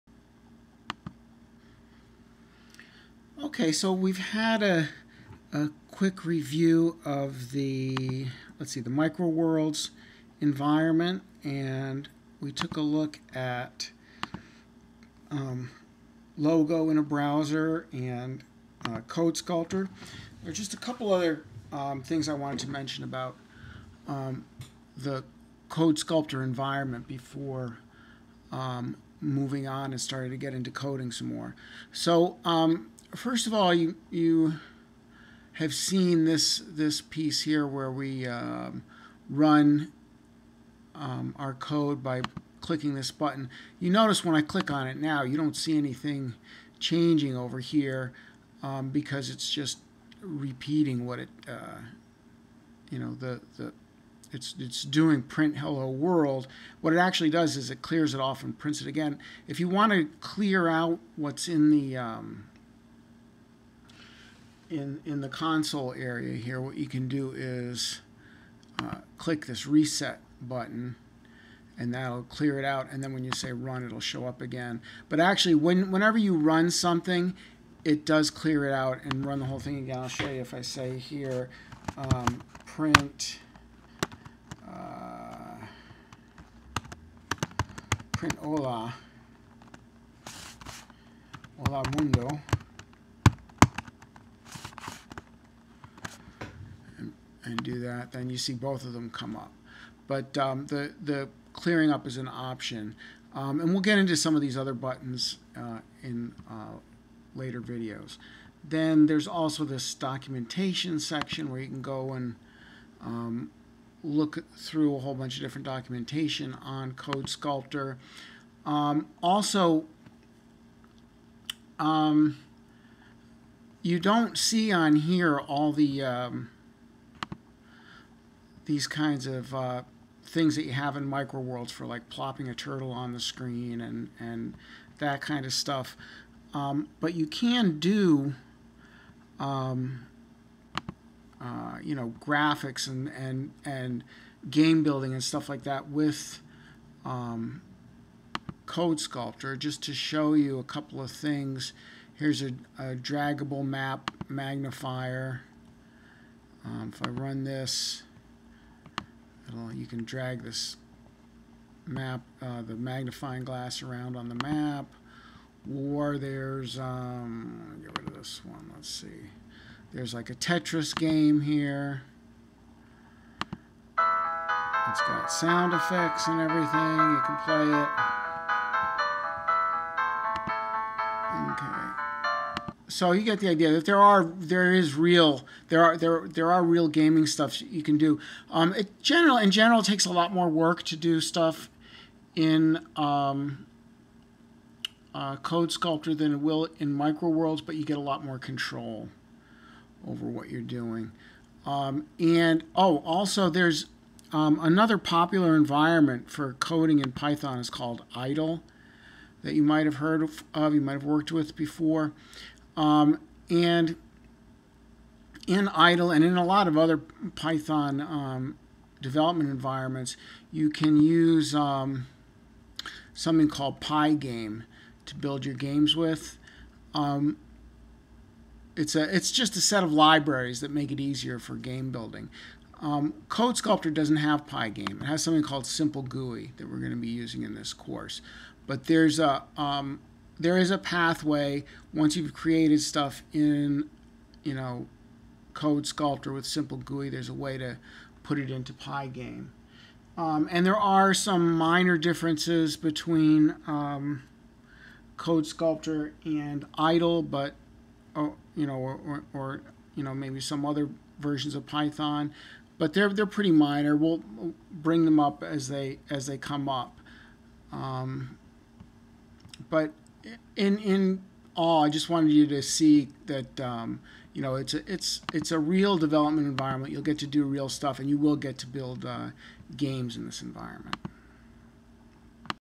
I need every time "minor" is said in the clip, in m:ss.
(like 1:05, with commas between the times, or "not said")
4:11, 4:23.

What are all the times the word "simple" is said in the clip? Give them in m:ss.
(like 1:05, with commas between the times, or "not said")
3:55, 4:06.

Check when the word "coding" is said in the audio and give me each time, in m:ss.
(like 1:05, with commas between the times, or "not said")
0:30, 3:26.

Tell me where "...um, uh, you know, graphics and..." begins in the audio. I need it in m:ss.
2:19.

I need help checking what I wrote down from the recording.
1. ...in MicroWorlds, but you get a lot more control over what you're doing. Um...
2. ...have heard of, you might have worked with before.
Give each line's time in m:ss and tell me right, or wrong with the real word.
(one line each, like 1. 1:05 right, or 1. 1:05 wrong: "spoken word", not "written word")
1. 3:16 right
2. 3:29 right.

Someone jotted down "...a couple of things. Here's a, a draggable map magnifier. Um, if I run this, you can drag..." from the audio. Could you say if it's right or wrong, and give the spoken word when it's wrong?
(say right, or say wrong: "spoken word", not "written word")
right.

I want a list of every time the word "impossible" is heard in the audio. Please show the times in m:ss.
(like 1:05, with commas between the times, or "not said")
not said.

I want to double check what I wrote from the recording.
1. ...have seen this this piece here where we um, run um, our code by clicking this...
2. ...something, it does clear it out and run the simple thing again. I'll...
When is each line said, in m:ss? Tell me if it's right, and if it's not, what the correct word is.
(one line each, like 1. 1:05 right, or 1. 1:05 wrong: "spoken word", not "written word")
1. 0:35 right
2. 1:16 wrong: "whole", not "simple".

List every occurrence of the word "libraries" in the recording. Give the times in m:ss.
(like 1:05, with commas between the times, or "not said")
3:49.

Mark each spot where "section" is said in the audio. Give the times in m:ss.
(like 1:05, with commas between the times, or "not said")
1:50.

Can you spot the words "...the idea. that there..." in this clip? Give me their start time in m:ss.
3:03.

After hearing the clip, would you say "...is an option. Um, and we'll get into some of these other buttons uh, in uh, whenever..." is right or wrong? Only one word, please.
wrong.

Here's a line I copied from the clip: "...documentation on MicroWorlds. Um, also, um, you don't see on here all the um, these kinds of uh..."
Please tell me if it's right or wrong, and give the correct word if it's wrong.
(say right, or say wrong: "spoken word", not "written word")
wrong: "CodeSkulptor", not "MicroWorlds".